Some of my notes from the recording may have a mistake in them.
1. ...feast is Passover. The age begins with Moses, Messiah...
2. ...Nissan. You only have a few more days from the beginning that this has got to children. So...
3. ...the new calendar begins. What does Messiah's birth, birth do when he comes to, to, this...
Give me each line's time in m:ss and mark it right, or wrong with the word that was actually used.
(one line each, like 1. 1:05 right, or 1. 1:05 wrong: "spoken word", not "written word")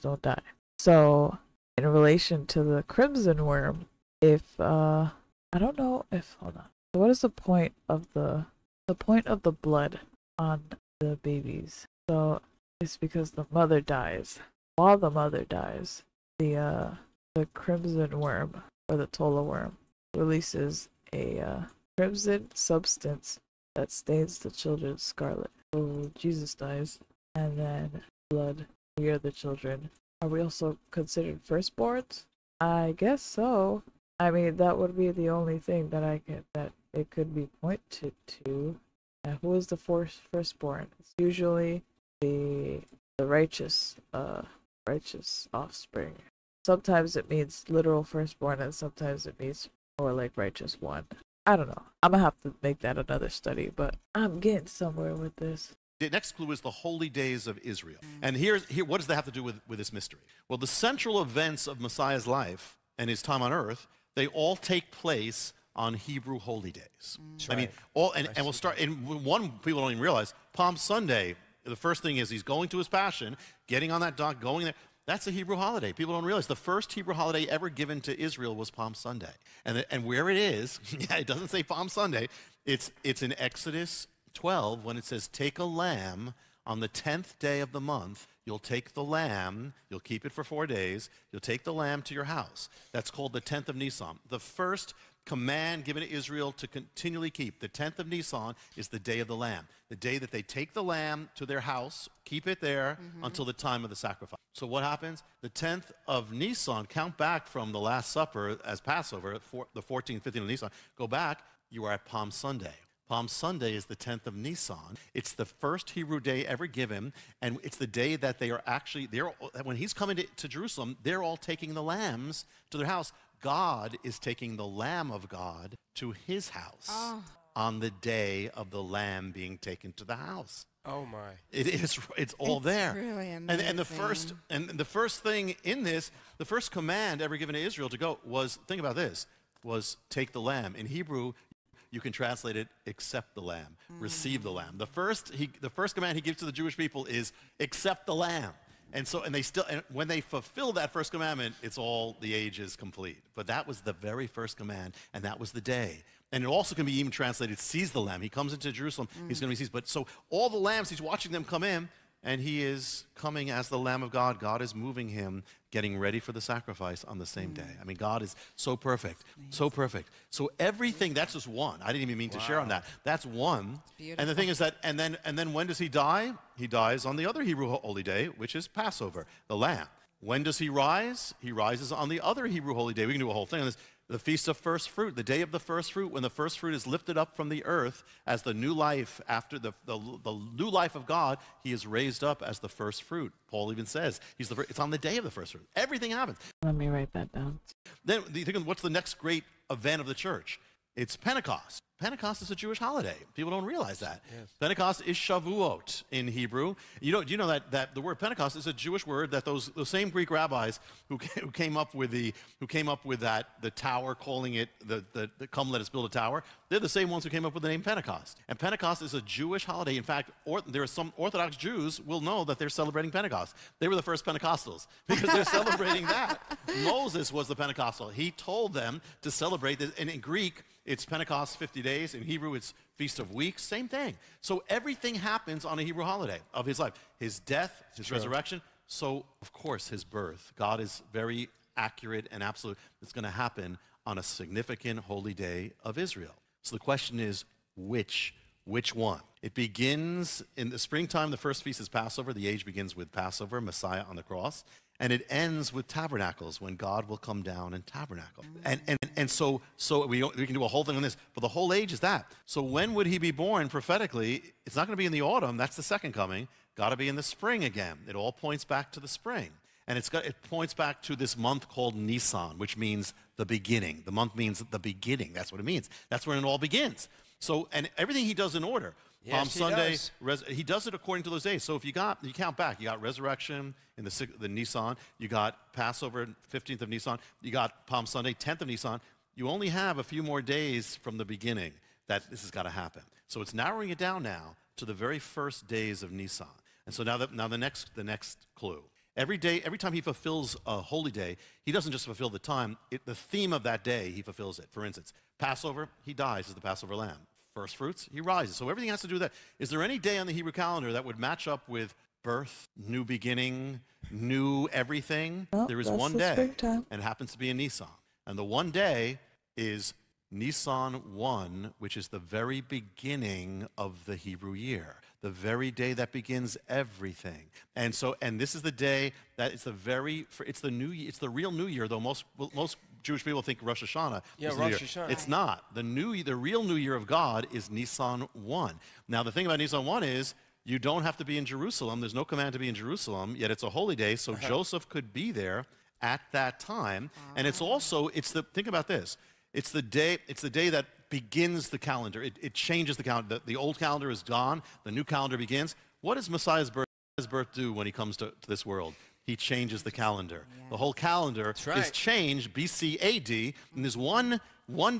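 1. 4:11 wrong: "Passover", not "Moses"
2. 4:48 wrong: "happen", not "children"
3. 5:54 right.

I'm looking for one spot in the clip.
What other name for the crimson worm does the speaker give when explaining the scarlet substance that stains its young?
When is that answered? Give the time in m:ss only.
0:19.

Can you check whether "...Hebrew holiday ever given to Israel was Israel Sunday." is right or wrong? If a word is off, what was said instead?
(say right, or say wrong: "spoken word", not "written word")
wrong: "Palm", not "Israel".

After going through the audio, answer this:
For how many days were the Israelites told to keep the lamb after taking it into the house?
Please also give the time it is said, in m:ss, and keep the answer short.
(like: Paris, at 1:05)
4, at 1:30.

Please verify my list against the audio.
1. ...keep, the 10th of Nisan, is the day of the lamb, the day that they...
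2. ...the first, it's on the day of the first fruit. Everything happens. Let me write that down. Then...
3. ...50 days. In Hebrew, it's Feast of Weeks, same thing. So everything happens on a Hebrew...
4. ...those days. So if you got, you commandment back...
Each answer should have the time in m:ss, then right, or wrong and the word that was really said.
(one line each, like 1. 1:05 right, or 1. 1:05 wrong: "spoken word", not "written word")
1. 1:37 right
2. 3:14 right
3. 3:51 right
4. 4:41 wrong: "count", not "commandment".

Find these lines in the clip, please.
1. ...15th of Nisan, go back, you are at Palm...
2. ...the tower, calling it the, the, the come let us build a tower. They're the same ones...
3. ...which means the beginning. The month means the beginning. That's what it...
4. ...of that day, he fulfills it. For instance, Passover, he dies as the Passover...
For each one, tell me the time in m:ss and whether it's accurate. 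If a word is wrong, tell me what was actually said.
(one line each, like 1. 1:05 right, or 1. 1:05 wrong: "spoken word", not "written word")
1. 1:50 right
2. 3:33 right
3. 4:32 right
4. 5:03 right.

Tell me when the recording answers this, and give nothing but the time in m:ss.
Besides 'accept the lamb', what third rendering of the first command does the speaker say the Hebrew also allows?
2:37.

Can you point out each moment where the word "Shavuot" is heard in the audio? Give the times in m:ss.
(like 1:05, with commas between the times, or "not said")
3:25.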